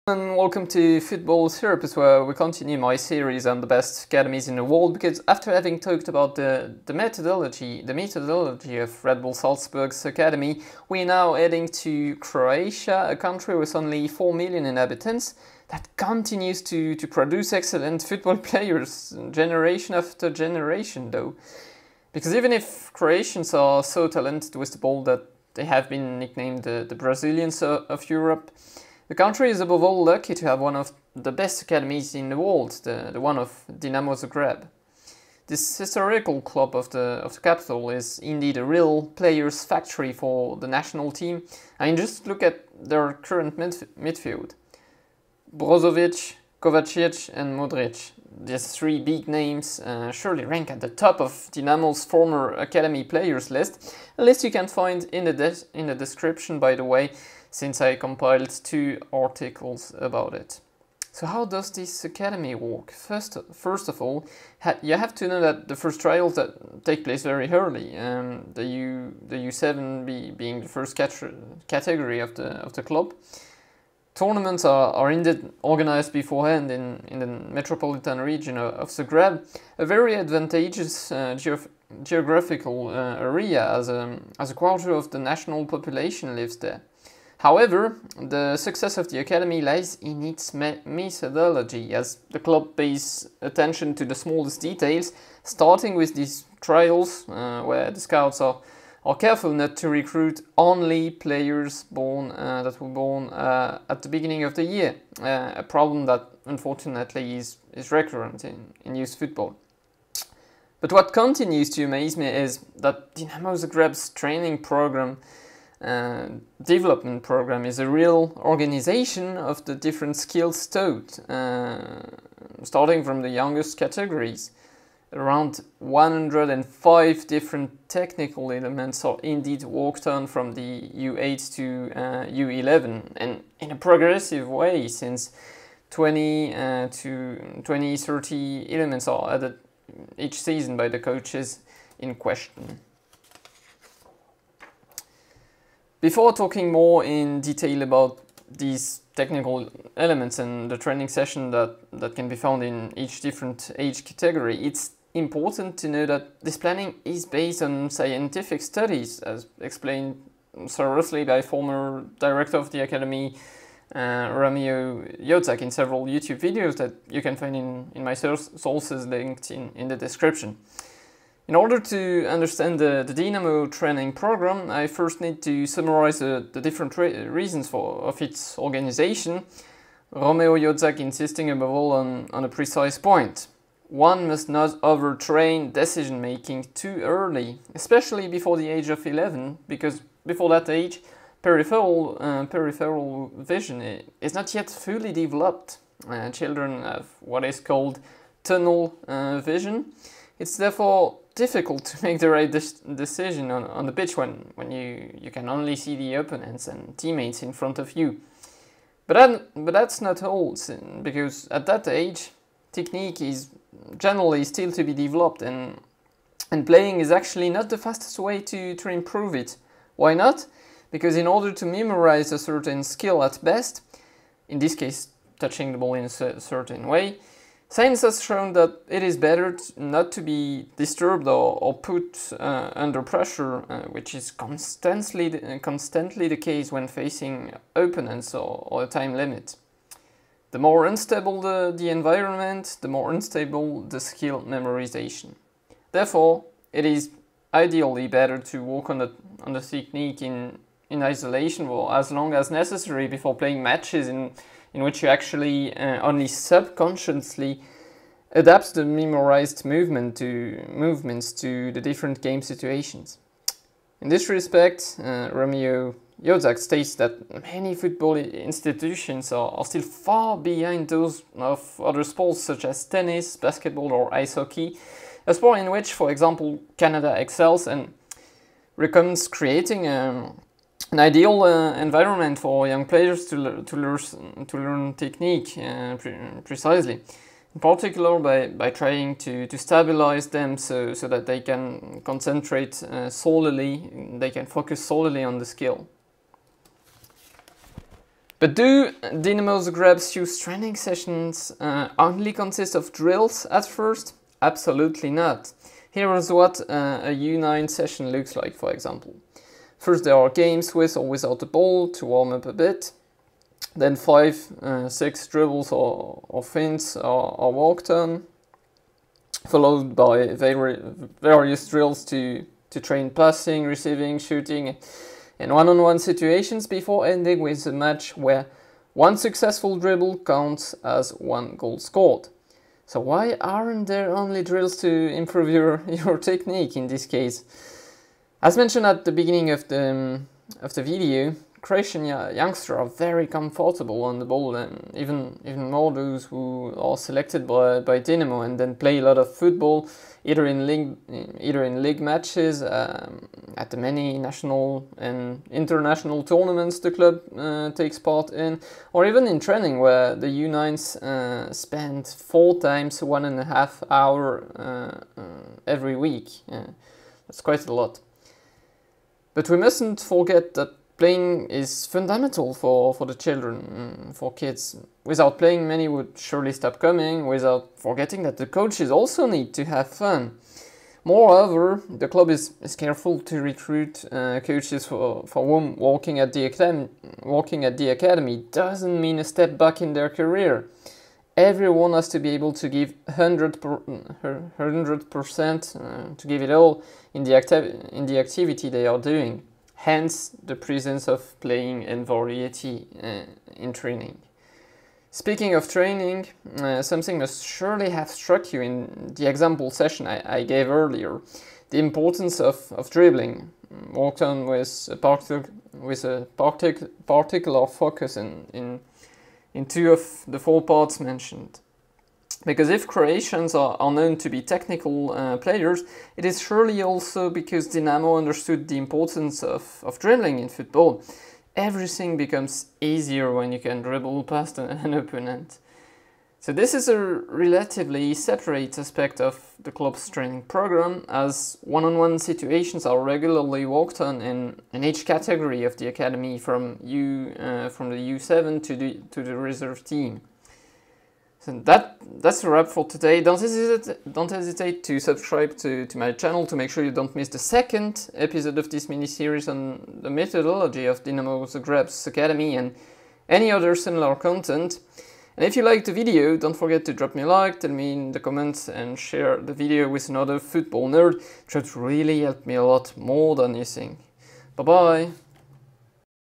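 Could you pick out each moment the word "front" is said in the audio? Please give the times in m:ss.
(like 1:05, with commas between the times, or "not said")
3:27.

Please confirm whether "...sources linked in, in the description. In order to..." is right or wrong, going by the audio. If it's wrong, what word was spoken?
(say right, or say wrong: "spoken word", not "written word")
right.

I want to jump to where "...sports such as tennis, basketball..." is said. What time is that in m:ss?
4:32.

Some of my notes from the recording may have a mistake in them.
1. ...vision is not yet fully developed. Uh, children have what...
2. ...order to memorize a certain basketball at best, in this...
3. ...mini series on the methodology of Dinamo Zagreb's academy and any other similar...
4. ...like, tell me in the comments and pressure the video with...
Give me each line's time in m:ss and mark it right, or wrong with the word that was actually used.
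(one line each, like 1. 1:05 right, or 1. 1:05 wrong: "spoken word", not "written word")
1. 3:13 right
2. 3:41 wrong: "skill", not "basketball"
3. 7:38 right
4. 7:47 wrong: "share", not "pressure".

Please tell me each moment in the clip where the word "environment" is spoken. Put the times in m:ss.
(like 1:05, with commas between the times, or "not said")
4:01, 4:41.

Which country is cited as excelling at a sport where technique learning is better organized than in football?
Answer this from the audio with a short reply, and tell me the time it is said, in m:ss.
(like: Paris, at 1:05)
Canada, at 4:36.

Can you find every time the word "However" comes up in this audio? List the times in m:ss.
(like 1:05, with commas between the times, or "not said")
1:27.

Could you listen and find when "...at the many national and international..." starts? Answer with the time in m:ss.
5:53.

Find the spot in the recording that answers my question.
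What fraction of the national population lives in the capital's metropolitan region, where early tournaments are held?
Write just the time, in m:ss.
1:24.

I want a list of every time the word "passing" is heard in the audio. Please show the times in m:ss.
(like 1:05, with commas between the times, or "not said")
5:23.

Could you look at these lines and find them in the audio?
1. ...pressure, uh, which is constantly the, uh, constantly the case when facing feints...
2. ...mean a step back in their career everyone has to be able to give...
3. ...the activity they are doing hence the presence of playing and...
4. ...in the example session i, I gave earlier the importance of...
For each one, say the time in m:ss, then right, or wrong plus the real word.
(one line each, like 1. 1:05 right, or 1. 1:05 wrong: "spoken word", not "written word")
1. 3:53 wrong: "opponents", not "feints"
2. 6:28 right
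3. 6:38 right
4. 6:48 right.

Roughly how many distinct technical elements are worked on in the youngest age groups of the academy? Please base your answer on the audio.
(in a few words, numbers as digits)
105.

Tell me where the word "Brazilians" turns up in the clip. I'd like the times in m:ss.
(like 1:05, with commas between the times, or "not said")
0:26.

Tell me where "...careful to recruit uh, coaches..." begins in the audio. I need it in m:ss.
6:22.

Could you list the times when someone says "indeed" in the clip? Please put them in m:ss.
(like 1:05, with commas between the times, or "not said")
0:38, 1:15, 2:09.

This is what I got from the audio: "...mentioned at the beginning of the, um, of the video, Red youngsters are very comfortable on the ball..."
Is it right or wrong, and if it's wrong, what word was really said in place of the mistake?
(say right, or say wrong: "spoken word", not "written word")
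wrong: "Croatian", not "Red".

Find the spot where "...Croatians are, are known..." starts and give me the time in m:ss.
7:02.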